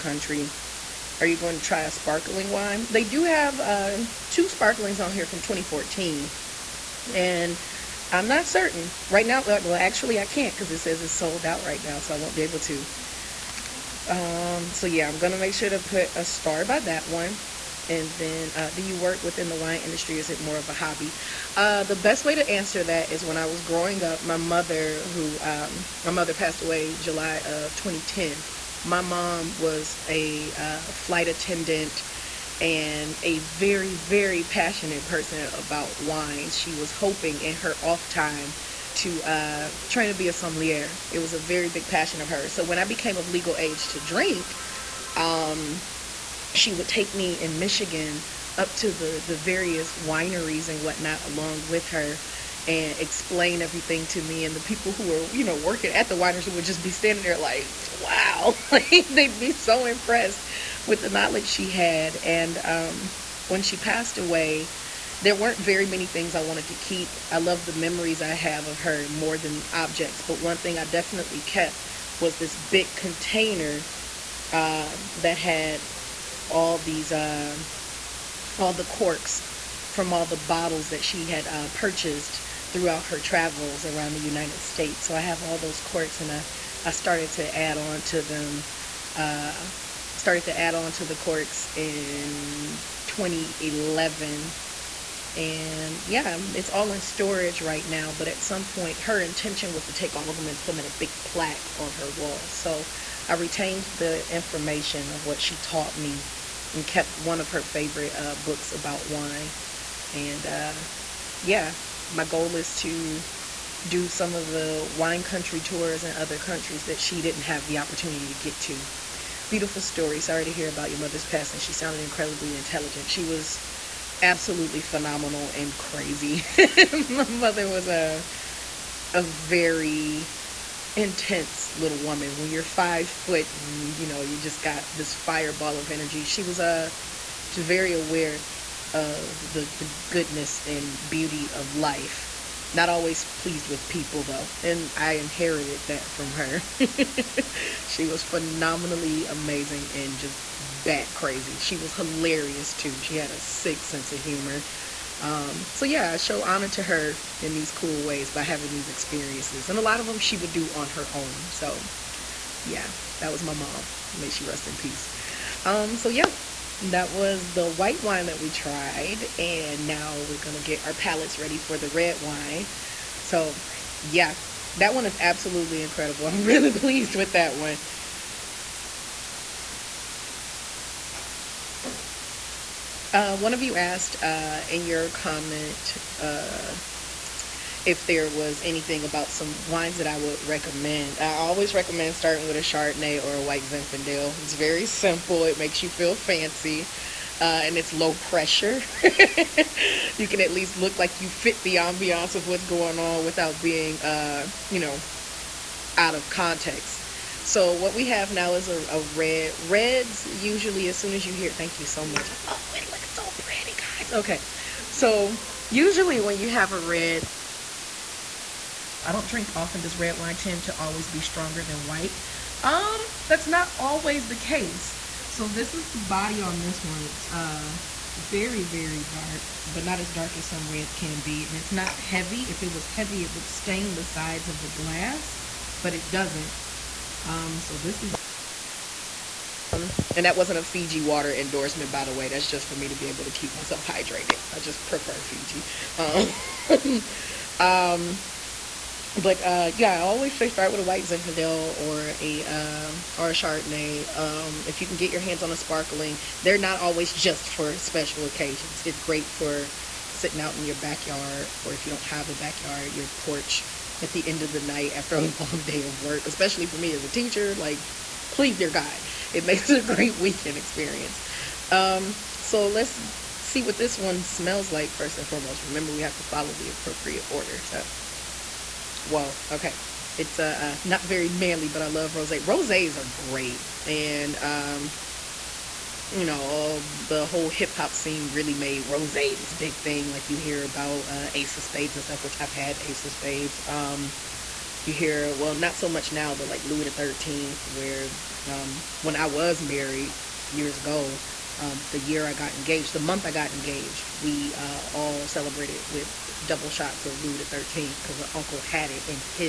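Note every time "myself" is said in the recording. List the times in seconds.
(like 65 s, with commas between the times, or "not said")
243 s.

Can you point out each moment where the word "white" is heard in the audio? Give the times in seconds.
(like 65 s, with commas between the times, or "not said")
167 s, 193 s, 221 s, 250 s.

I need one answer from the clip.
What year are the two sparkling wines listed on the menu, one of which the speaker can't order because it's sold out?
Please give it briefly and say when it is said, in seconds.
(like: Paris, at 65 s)
2014, at 5 s.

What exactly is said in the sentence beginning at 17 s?
And then, uh, do you work within the wine industry?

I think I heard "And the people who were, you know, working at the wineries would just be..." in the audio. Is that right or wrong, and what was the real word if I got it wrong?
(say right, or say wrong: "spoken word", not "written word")
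right.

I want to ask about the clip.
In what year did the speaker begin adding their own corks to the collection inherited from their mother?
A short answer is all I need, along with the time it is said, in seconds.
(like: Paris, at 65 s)
2011, at 93 s.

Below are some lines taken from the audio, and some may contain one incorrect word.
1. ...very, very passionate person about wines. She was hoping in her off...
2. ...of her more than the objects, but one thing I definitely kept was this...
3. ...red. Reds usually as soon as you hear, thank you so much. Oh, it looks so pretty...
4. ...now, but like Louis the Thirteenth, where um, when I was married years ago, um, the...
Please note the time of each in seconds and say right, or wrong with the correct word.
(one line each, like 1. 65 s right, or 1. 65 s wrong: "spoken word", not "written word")
1. 33 s right
2. 68 s right
3. 209 s right
4. 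296 s right.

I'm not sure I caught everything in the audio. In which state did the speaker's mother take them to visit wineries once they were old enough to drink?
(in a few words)
Michigan.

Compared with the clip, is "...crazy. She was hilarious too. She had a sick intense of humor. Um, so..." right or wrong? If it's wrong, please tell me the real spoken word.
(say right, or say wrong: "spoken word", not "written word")
wrong: "sense", not "intense".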